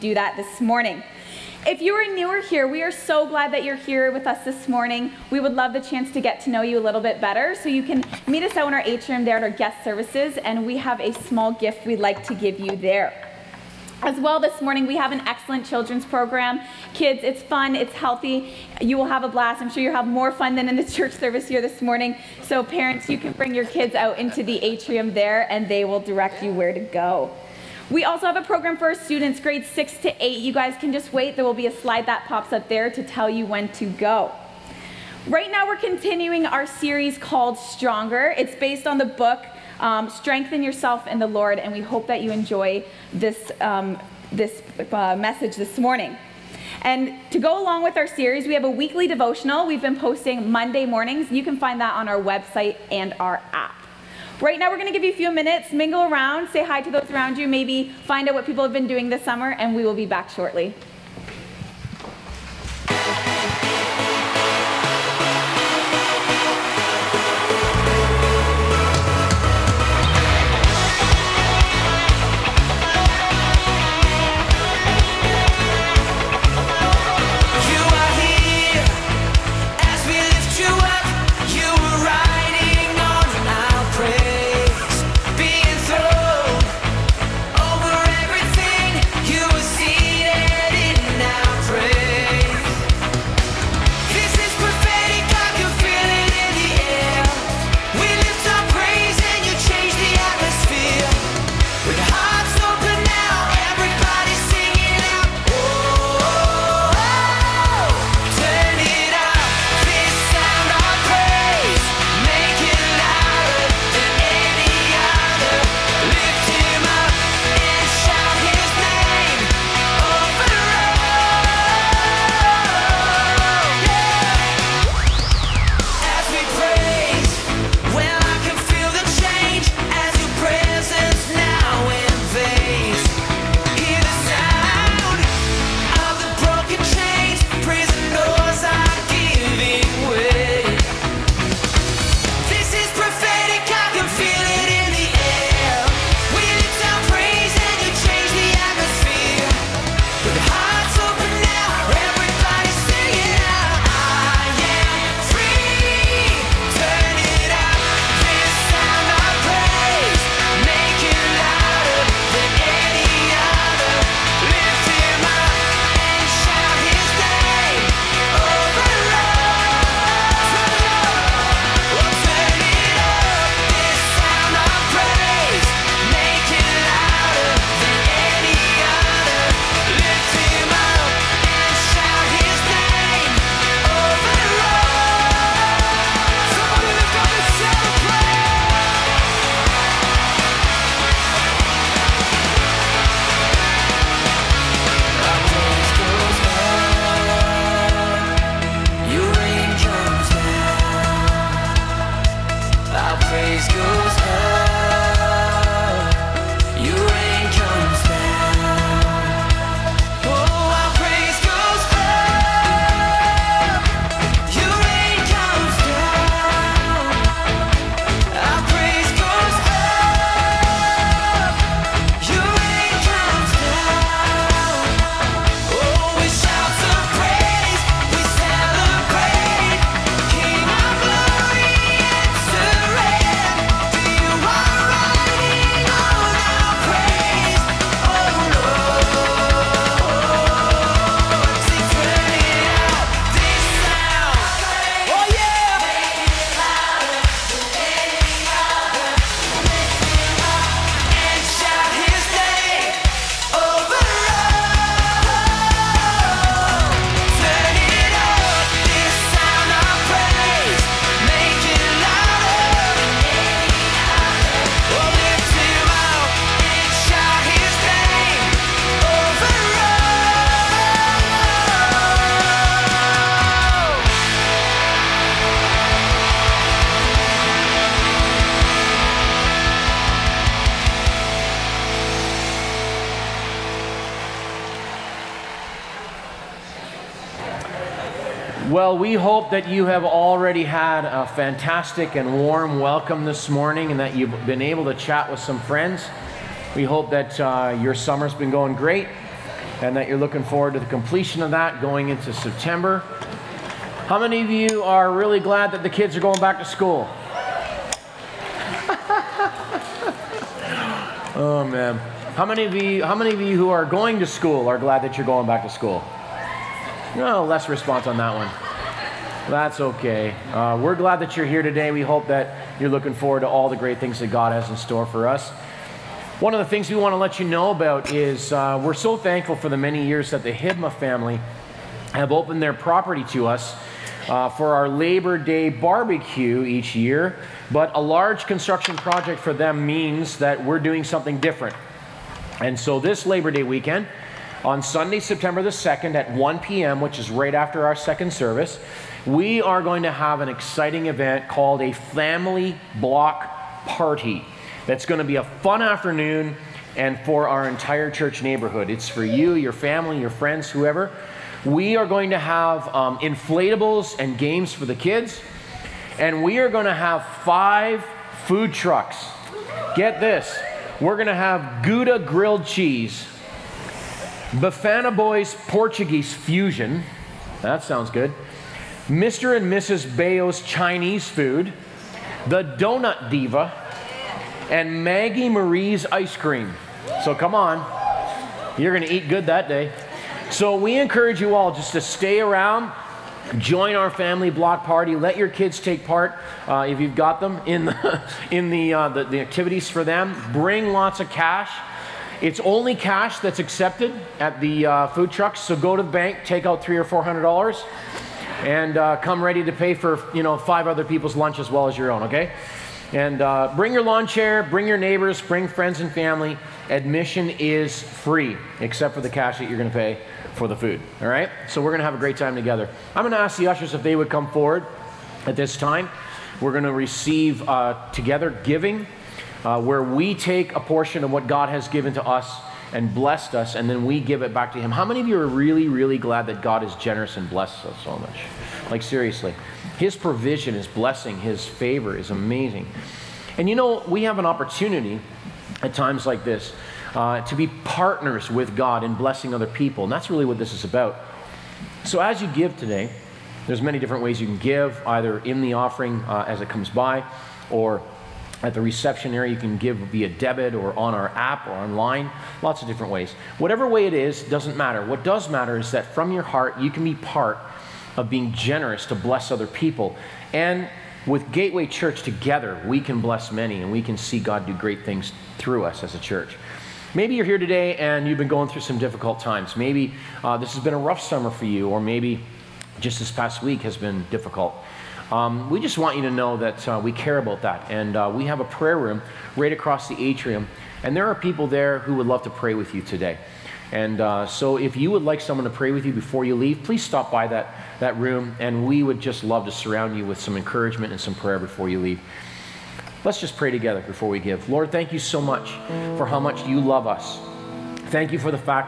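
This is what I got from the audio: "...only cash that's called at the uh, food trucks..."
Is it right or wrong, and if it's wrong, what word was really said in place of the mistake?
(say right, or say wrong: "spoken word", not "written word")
wrong: "accepted", not "called".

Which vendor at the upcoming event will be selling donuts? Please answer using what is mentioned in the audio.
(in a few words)
the Donut Diva.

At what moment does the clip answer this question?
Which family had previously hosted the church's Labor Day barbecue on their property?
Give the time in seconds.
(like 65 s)
330 s.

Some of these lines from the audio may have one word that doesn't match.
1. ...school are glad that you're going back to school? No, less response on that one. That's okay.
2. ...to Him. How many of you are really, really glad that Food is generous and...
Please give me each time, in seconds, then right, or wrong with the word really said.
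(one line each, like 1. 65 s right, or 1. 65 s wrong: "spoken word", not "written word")
1. 314 s right
2. 434 s wrong: "God", not "Food".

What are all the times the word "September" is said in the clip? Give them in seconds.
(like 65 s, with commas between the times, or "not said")
302 s, 345 s.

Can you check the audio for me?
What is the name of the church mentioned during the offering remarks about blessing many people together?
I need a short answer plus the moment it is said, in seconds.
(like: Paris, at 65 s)
Gateway Church, at 471 s.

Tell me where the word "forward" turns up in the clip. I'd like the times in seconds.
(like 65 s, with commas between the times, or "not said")
300 s, 323 s, 424 s.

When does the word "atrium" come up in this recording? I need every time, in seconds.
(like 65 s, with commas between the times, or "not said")
8 s, 24 s, 490 s.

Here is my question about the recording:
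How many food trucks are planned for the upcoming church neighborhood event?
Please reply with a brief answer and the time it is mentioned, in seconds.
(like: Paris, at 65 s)
5, at 367 s.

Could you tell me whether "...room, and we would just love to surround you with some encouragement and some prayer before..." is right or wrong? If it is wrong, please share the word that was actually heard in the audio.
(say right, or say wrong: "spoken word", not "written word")
right.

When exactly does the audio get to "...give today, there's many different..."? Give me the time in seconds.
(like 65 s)
452 s.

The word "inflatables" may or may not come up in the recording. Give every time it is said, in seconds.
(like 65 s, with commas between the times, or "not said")
363 s.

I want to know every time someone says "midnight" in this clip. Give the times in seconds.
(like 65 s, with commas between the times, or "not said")
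not said.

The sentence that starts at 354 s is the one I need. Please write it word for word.
That's going to be a fun afternoon and for our entire church neighborhood.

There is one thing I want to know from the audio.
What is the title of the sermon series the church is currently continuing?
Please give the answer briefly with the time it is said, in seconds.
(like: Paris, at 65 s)
Stronger, at 37 s.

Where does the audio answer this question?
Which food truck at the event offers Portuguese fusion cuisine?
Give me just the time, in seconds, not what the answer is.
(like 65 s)
374 s.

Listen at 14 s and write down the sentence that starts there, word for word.
As well, this morning we have an excellent children's program.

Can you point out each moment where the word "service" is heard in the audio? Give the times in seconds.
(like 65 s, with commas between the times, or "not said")
9 s, 21 s, 348 s.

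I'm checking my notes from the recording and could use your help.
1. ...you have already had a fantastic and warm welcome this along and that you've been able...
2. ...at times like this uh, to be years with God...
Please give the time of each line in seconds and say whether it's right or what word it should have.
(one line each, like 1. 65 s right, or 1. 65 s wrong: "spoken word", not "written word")
1. 289 s wrong: "morning", not "along"
2. 445 s wrong: "partners", not "years".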